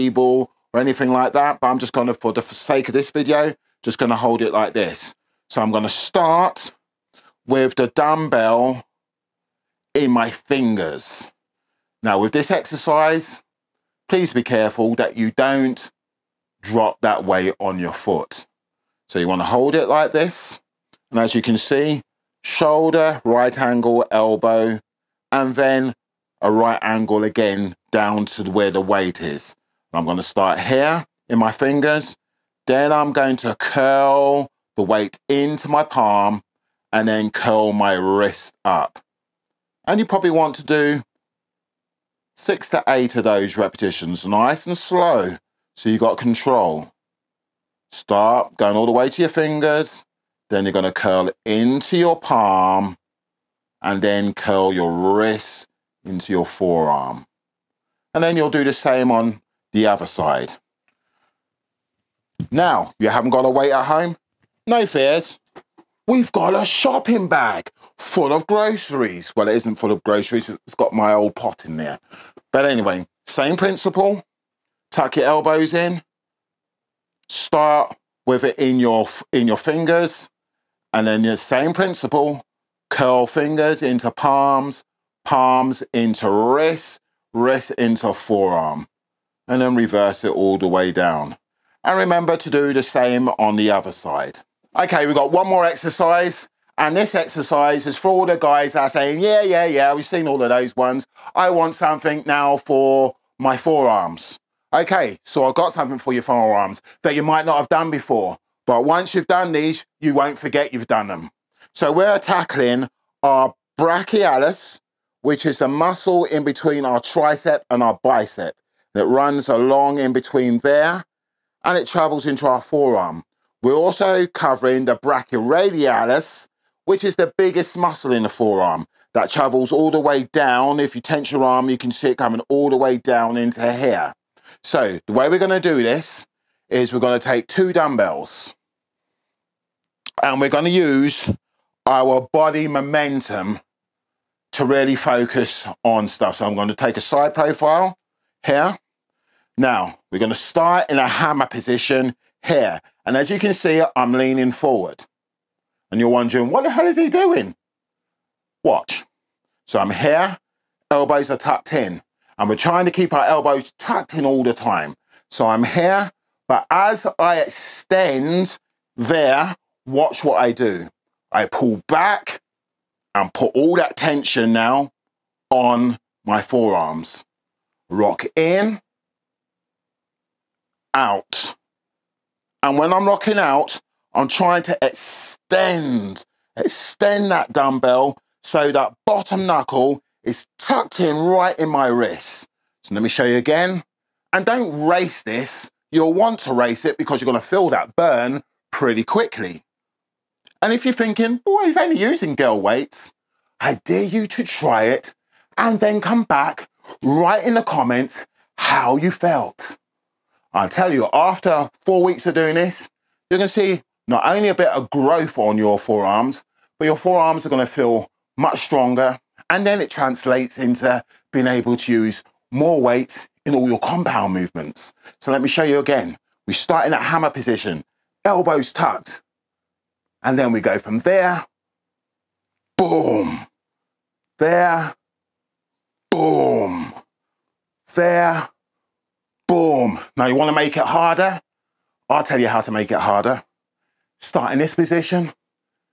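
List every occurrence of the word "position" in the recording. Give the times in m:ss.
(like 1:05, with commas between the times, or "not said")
2:31, 3:47, 4:04.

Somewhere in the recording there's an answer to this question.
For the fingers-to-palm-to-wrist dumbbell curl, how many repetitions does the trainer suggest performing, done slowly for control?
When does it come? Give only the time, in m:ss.
0:42.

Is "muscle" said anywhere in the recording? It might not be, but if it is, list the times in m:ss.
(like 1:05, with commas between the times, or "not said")
1:55, 2:07.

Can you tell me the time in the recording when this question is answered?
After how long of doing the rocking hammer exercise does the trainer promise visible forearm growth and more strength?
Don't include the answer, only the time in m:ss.
3:31.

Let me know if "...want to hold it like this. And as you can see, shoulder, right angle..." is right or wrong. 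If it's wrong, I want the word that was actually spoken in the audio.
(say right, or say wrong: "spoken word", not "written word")
right.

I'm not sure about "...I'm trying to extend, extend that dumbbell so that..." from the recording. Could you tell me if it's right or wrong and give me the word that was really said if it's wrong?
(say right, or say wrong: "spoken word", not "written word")
right.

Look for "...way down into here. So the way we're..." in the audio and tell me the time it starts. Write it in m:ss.
2:12.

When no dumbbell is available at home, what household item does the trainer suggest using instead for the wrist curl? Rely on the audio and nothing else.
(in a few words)
Shopping bag.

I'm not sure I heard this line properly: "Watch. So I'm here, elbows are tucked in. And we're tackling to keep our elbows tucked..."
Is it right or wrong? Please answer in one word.
wrong.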